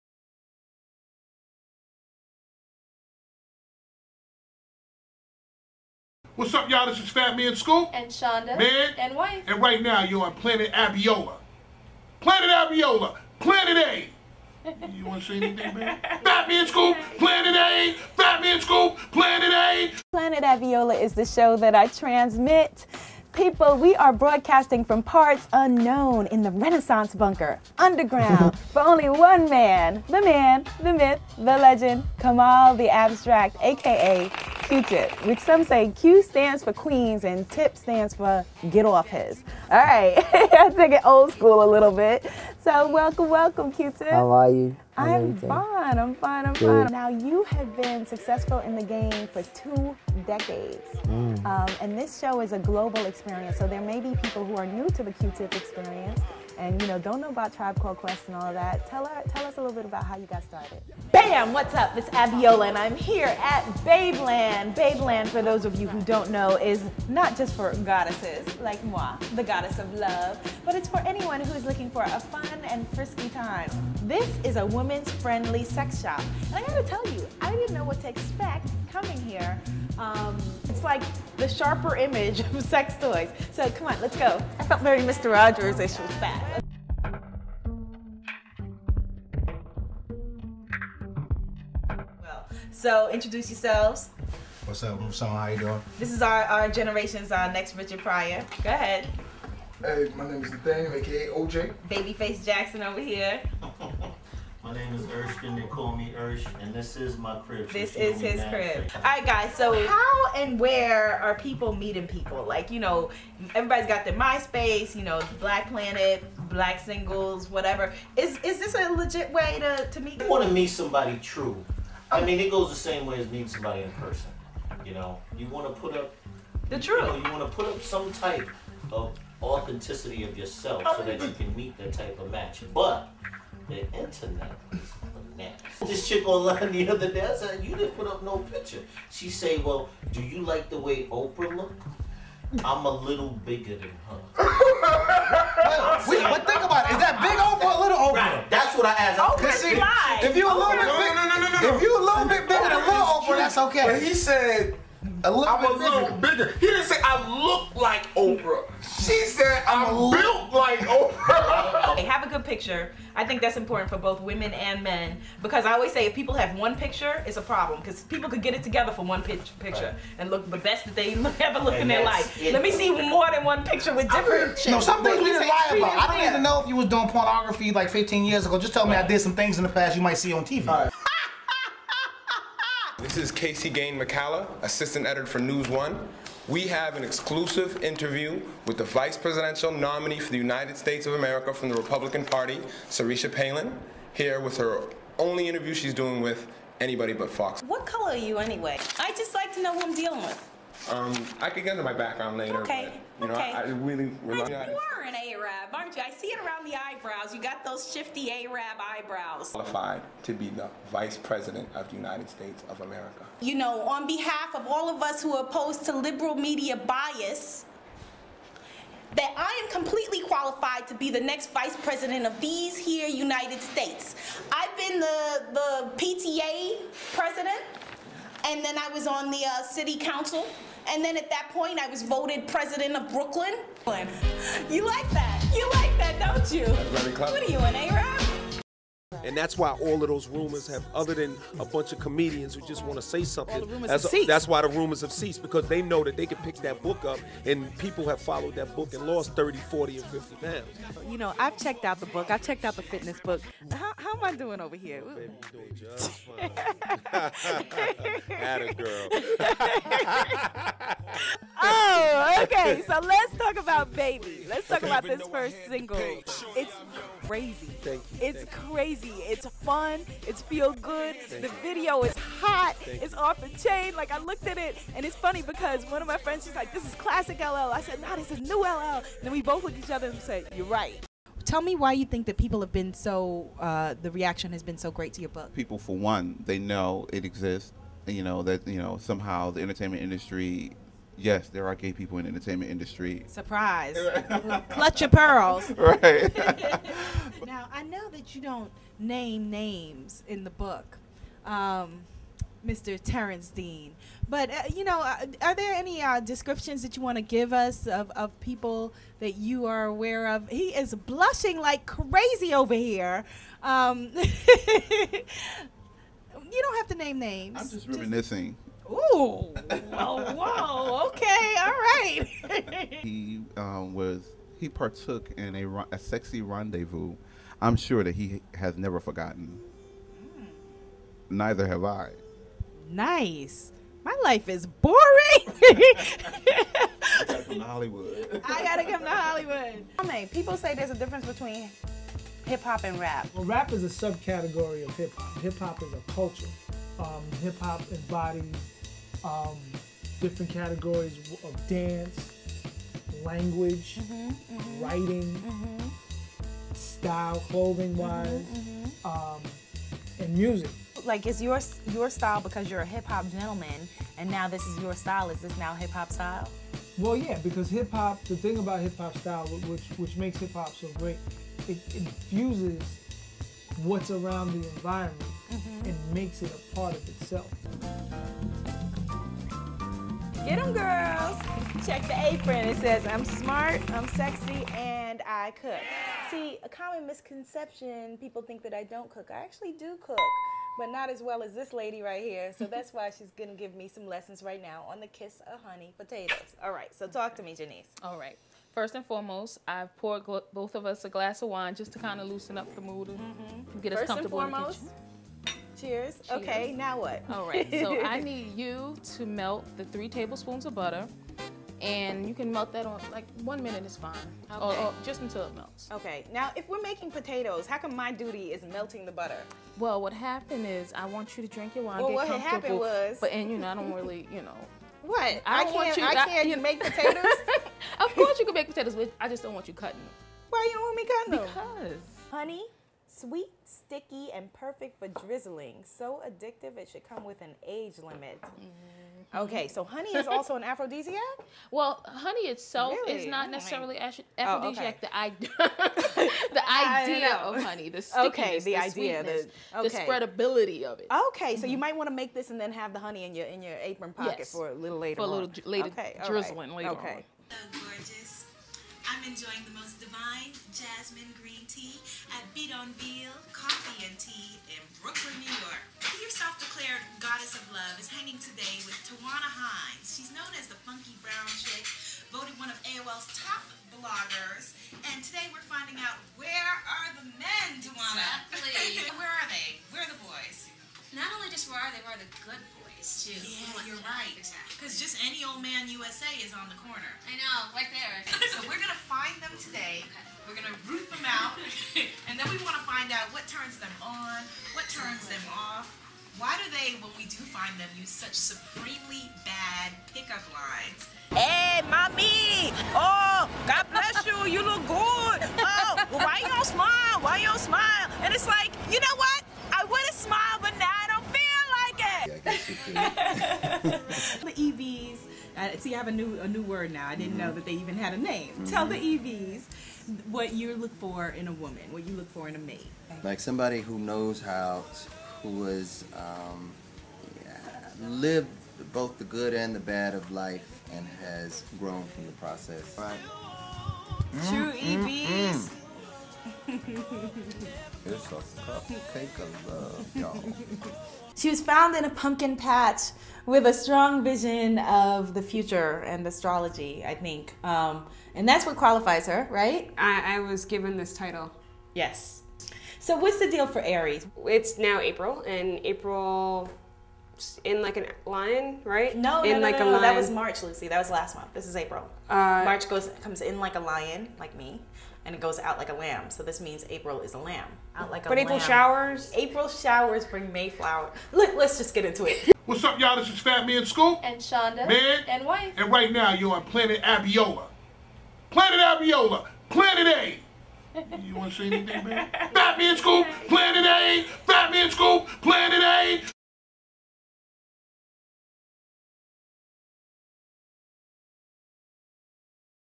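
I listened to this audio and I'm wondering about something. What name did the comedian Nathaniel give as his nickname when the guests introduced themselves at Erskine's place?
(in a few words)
OJ.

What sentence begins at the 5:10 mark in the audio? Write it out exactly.
He is blushing like crazy over here.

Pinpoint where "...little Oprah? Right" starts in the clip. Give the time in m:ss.
2:27.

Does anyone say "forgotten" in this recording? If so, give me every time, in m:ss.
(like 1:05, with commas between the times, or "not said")
5:28.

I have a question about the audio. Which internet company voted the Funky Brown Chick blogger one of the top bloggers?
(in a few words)
AOL.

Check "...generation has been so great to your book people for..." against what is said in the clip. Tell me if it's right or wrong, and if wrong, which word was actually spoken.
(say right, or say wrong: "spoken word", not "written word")
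wrong: "reaction", not "generation".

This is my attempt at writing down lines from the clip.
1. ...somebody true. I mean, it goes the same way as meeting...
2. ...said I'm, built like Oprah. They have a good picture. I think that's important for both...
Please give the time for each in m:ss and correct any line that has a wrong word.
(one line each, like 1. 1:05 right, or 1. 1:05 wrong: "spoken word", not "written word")
1. 2:00 right
2. 2:39 right.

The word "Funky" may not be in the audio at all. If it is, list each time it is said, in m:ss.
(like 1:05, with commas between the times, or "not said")
7:50.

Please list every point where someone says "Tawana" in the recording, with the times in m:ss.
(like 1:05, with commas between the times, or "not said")
7:49, 7:57.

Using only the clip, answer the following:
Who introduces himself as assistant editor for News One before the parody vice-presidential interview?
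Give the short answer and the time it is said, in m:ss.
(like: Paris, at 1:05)
Casey Gane McCalla, at 3:03.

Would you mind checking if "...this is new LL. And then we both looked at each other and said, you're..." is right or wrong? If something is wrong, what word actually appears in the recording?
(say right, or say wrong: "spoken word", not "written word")
right.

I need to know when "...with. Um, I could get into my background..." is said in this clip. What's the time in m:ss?
3:20.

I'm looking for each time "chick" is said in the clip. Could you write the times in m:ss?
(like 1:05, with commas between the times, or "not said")
2:16, 7:51.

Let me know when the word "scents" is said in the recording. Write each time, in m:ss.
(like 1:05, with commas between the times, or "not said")
not said.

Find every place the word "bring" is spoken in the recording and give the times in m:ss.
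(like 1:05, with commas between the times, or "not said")
9:30.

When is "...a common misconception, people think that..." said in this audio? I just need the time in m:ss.
6:26.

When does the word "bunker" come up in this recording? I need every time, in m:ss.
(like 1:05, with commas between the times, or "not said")
0:27.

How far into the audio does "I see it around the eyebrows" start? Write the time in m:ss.
3:26.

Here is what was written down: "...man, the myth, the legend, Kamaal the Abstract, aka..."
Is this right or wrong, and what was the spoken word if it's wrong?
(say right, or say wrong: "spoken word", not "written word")
right.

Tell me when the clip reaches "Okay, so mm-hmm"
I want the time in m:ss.
7:31.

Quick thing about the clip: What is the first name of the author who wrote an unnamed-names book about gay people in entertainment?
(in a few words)
Terrence.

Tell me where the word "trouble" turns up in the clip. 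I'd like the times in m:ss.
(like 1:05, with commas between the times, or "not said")
not said.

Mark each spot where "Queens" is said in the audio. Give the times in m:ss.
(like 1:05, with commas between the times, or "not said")
0:36.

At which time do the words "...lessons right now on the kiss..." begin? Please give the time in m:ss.
6:34.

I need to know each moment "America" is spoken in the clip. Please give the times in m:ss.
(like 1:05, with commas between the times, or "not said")
3:11, 3:32.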